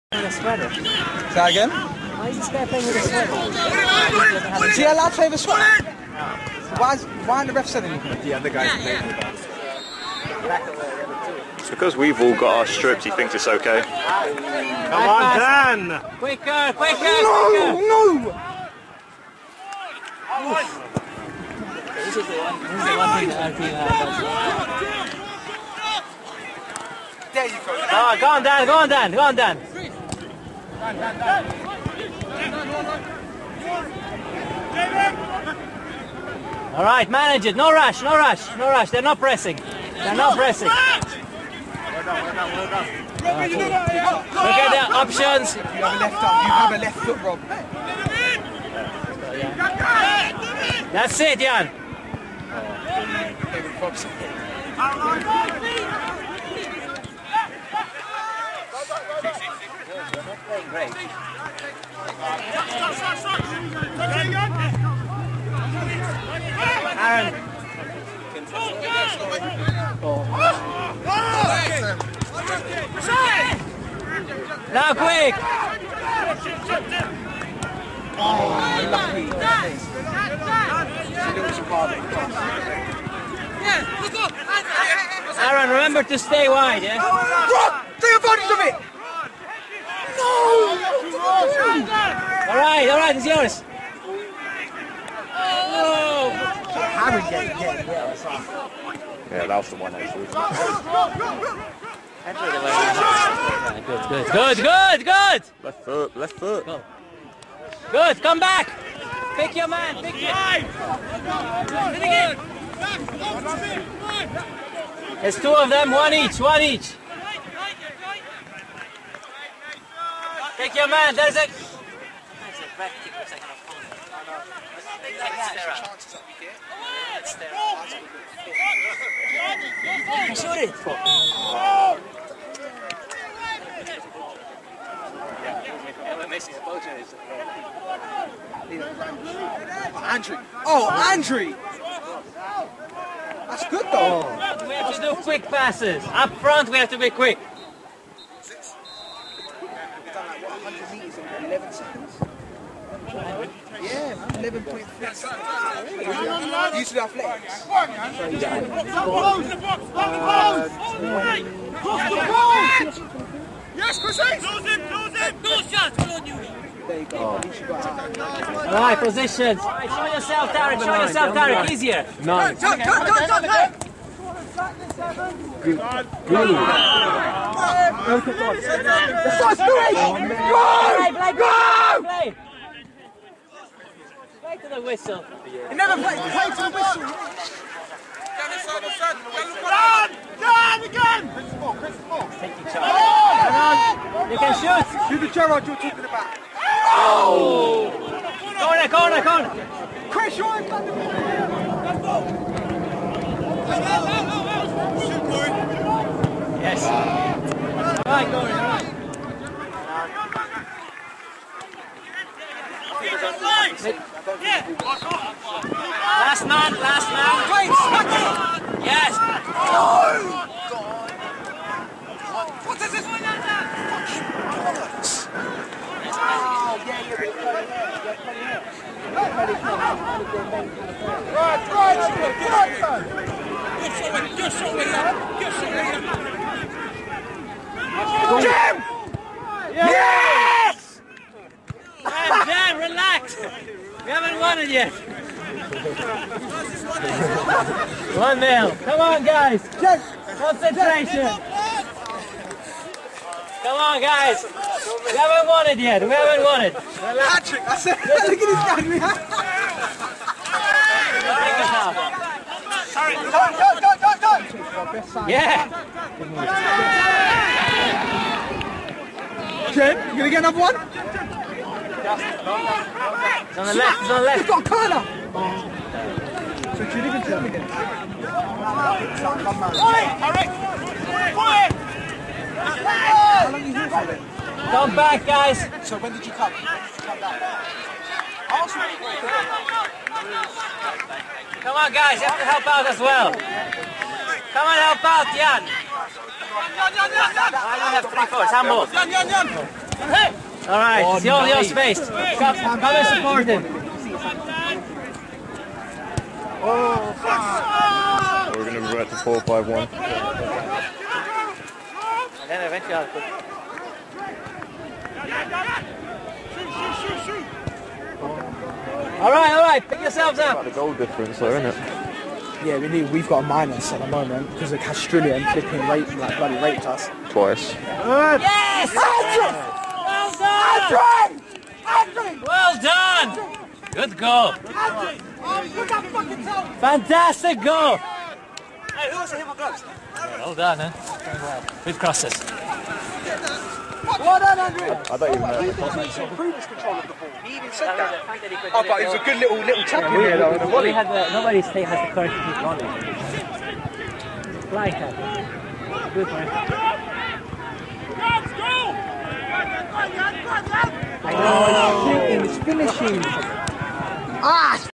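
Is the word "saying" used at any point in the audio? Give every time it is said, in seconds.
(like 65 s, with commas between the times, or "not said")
7 s.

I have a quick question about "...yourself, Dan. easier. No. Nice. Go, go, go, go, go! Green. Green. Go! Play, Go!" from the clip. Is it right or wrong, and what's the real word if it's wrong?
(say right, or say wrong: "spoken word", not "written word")
wrong: "Derek", not "Dan".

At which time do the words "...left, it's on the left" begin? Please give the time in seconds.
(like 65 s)
273 s.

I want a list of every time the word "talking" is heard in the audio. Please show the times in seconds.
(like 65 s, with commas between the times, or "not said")
195 s.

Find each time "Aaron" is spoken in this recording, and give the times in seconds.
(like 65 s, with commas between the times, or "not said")
60 s, 85 s.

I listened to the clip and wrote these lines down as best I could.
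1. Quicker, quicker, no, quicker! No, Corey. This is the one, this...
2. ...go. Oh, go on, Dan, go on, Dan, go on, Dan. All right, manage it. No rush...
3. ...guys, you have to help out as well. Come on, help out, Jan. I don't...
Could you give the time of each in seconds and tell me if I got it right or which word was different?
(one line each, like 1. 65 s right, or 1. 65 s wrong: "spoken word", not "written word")
1. 16 s wrong: "Oof", not "Corey"
2. 27 s right
3. 291 s right.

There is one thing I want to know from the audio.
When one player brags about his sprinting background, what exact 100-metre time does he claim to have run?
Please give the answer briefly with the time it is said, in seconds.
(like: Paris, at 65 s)
11.3 seconds, at 154 s.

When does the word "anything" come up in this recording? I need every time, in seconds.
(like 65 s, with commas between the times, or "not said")
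7 s.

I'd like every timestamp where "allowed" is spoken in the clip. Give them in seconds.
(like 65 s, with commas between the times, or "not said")
4 s.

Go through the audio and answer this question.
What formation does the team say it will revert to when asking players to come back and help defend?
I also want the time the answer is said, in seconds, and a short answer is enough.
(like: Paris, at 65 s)
4-5-1, at 309 s.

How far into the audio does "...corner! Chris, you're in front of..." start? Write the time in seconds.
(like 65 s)
199 s.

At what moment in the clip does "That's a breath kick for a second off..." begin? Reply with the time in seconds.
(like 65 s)
121 s.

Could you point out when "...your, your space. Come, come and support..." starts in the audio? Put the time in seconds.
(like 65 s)
301 s.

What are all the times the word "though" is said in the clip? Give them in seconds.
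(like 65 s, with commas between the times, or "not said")
143 s, 321 s, 350 s.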